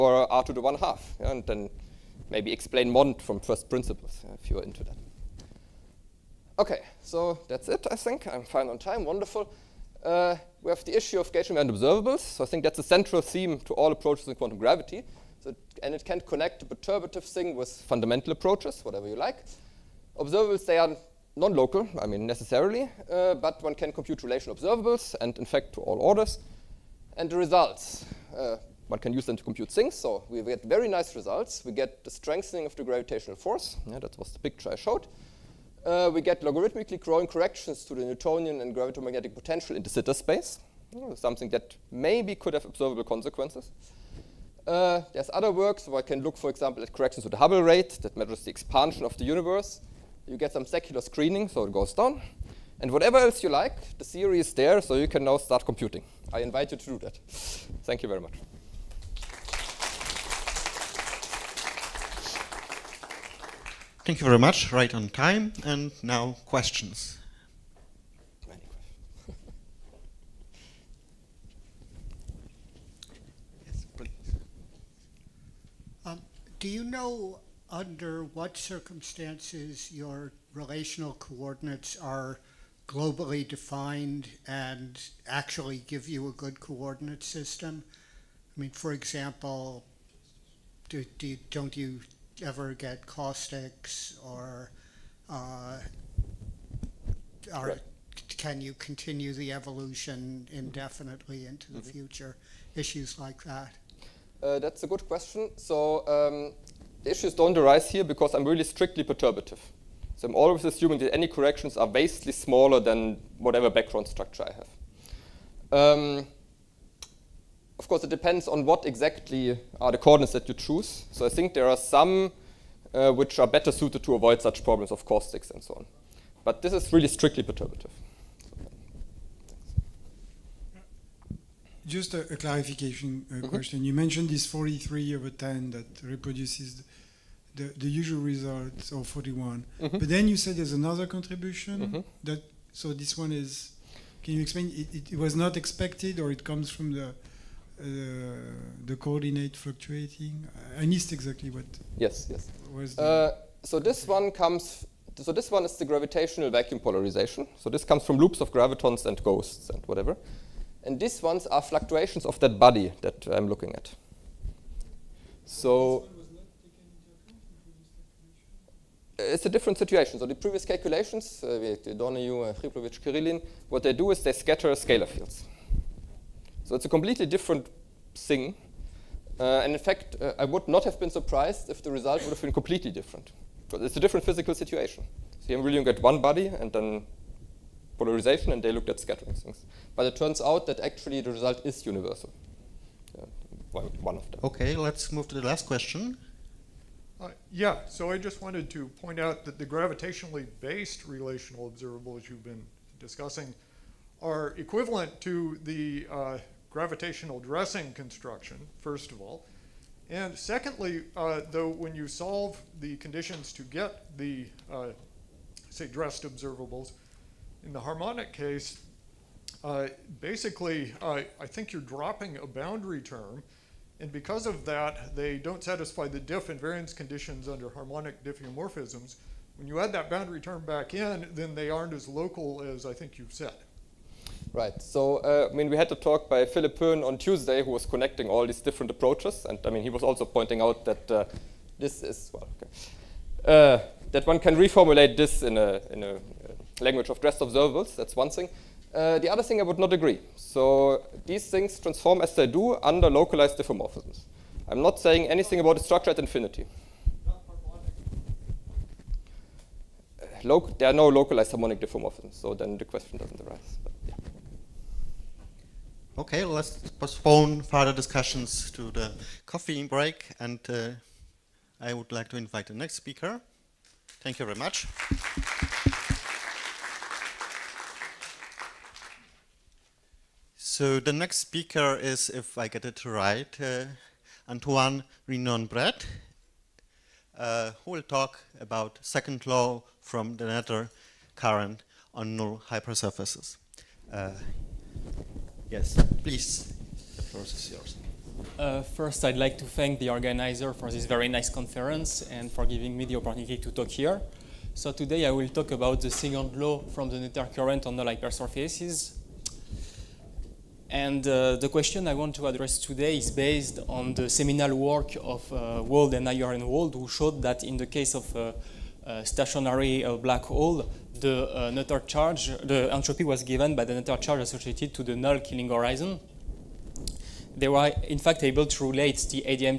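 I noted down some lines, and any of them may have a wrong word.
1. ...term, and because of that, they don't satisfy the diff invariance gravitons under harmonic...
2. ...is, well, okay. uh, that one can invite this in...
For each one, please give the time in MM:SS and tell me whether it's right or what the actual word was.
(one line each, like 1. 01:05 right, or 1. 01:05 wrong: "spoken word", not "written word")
1. 03:43 wrong: "conditions", not "gravitons"
2. 04:02 wrong: "reformulate", not "invite".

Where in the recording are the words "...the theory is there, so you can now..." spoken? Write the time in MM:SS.
00:53.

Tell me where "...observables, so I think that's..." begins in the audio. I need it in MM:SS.
00:11.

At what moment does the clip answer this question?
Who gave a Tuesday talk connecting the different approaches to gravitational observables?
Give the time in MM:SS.
03:56.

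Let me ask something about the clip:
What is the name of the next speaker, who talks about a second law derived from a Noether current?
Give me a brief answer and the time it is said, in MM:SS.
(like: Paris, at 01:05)
Antoine Rignon-Bret, at 04:44.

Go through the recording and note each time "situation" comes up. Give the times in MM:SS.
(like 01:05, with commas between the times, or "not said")
02:49, 03:04.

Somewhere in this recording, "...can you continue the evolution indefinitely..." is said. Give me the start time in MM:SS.
01:38.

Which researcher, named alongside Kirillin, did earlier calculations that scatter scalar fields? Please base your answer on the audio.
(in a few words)
Donoghue.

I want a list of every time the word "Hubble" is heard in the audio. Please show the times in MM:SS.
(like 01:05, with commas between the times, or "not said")
00:47.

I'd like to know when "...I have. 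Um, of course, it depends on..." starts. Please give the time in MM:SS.
01:54.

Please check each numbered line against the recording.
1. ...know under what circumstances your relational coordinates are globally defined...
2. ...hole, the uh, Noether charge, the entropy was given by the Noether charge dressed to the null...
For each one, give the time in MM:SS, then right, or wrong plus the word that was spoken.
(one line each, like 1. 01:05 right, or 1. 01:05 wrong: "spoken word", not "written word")
1. 01:16 right
2. 05:20 wrong: "associated", not "dressed".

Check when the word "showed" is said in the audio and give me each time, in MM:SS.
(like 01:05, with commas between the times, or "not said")
00:34, 05:17.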